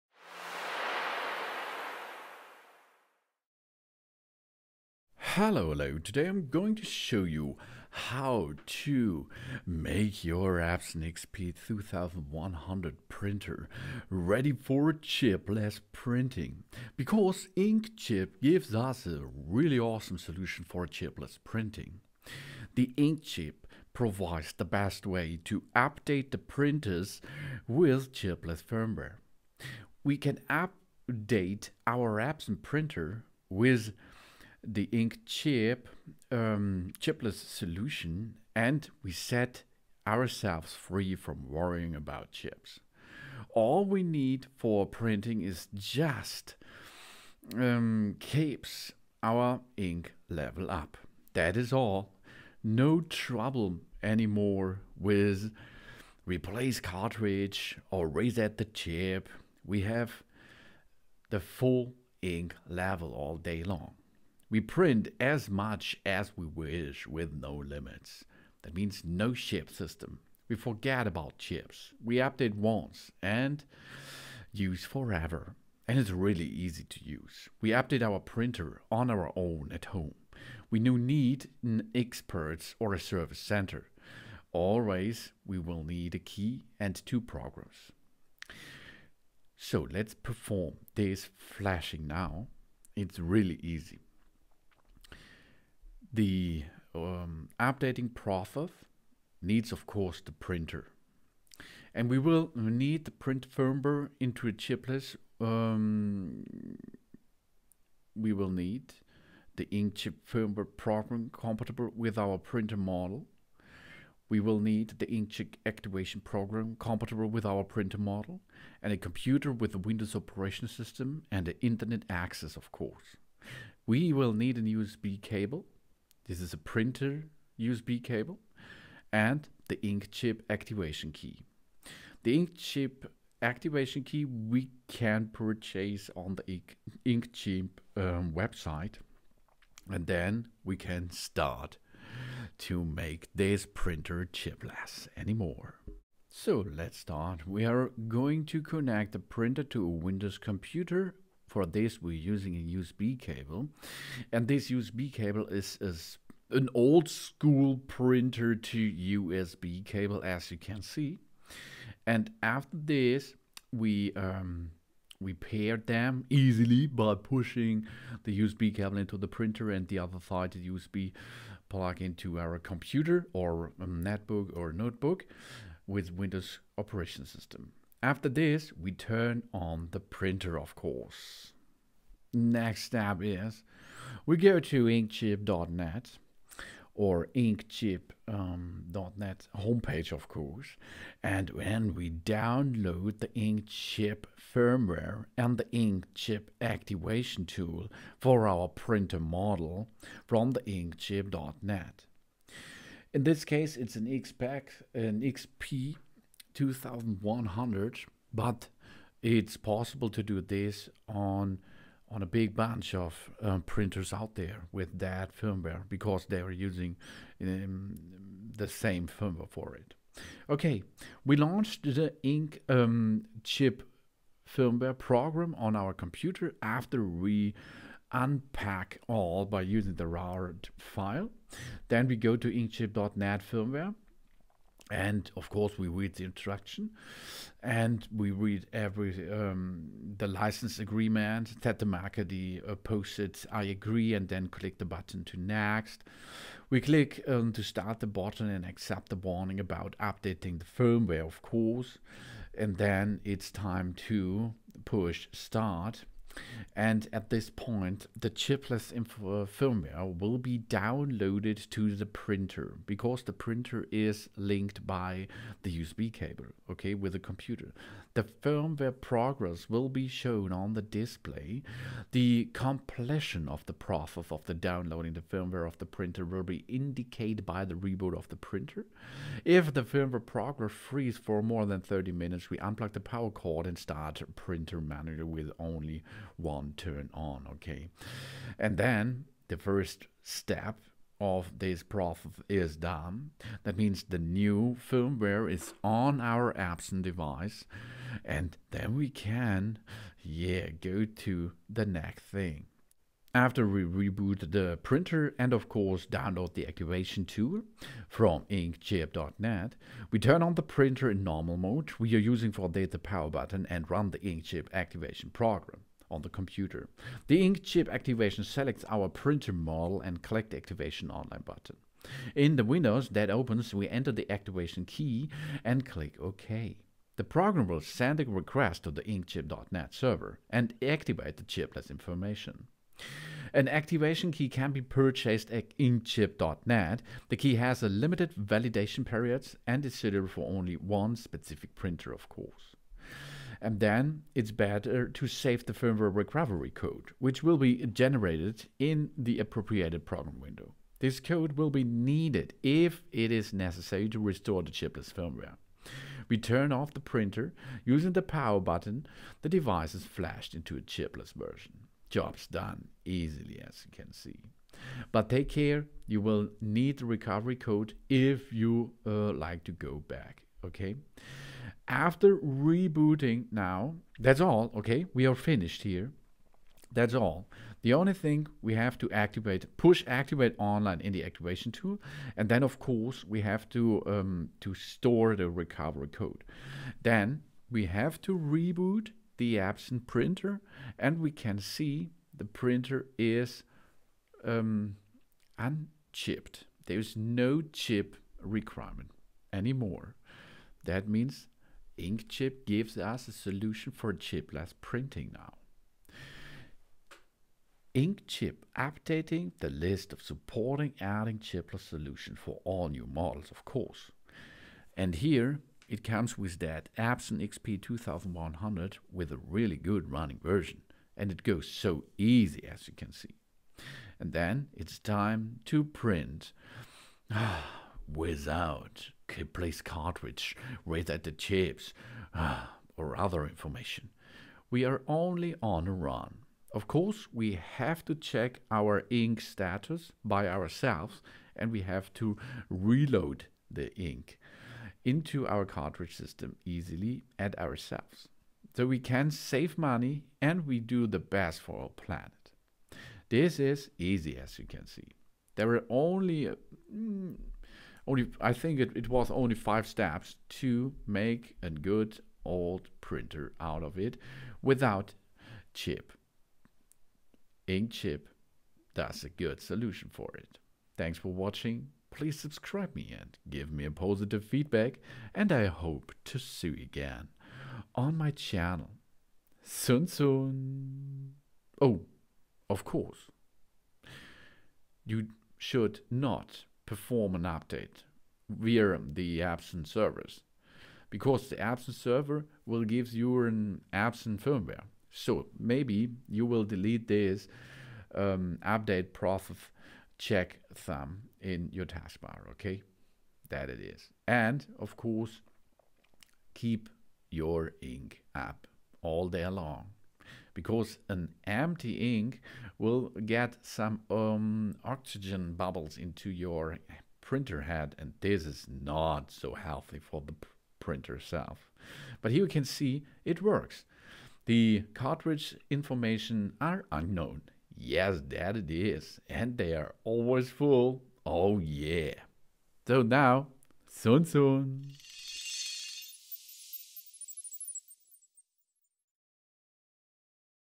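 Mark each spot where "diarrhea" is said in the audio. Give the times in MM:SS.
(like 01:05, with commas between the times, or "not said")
not said.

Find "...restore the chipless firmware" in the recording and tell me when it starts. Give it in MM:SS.
05:54.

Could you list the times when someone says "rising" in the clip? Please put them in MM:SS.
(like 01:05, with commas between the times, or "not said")
not said.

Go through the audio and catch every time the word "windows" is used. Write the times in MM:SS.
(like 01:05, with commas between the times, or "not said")
01:59, 02:29, 02:56, 05:22, 05:50.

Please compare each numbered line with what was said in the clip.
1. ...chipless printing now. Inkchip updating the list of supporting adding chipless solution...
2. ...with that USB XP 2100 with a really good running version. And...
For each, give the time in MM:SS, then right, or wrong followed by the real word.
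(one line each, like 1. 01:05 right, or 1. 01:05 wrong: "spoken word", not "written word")
1. 06:44 right
2. 06:56 wrong: "Epson", not "USB".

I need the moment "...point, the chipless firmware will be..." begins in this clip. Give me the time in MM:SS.
04:17.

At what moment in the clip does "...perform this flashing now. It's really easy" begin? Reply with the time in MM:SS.
01:30.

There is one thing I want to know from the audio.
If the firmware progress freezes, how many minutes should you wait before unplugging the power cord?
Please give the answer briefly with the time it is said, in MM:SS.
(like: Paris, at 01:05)
30, at 04:41.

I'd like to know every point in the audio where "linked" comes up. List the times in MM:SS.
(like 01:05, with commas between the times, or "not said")
04:24.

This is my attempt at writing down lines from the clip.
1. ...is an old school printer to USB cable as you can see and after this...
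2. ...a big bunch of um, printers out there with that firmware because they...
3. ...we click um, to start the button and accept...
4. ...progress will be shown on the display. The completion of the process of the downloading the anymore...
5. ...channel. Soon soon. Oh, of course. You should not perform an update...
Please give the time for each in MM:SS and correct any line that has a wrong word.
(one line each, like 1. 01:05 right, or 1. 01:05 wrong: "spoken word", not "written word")
1. 02:35 right
2. 03:32 right
3. 04:06 right
4. 04:28 wrong: "firmware", not "anymore"
5. 07:58 right.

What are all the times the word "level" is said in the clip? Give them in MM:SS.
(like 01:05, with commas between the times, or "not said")
00:50, 01:02.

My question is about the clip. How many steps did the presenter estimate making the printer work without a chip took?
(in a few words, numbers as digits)
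5.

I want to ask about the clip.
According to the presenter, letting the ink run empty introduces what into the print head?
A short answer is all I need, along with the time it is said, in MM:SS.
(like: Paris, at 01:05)
Oxygen bubbles, at 08:34.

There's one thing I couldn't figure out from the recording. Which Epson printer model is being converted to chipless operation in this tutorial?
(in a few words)
XP2100.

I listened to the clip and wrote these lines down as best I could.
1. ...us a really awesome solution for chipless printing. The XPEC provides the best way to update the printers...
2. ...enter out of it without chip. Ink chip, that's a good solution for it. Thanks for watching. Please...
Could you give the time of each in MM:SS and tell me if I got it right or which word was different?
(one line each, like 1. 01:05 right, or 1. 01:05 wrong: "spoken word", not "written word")
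1. 00:18 wrong: "InkChip", not "XPEC"
2. 07:42 wrong: "printer", not "enter".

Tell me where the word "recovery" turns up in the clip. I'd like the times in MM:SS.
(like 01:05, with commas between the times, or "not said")
05:46, 06:07, 06:25.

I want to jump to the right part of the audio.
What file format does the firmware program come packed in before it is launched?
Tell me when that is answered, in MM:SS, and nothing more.
03:50.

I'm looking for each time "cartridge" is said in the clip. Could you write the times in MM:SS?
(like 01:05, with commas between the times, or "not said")
00:56, 07:09, 07:25, 08:44.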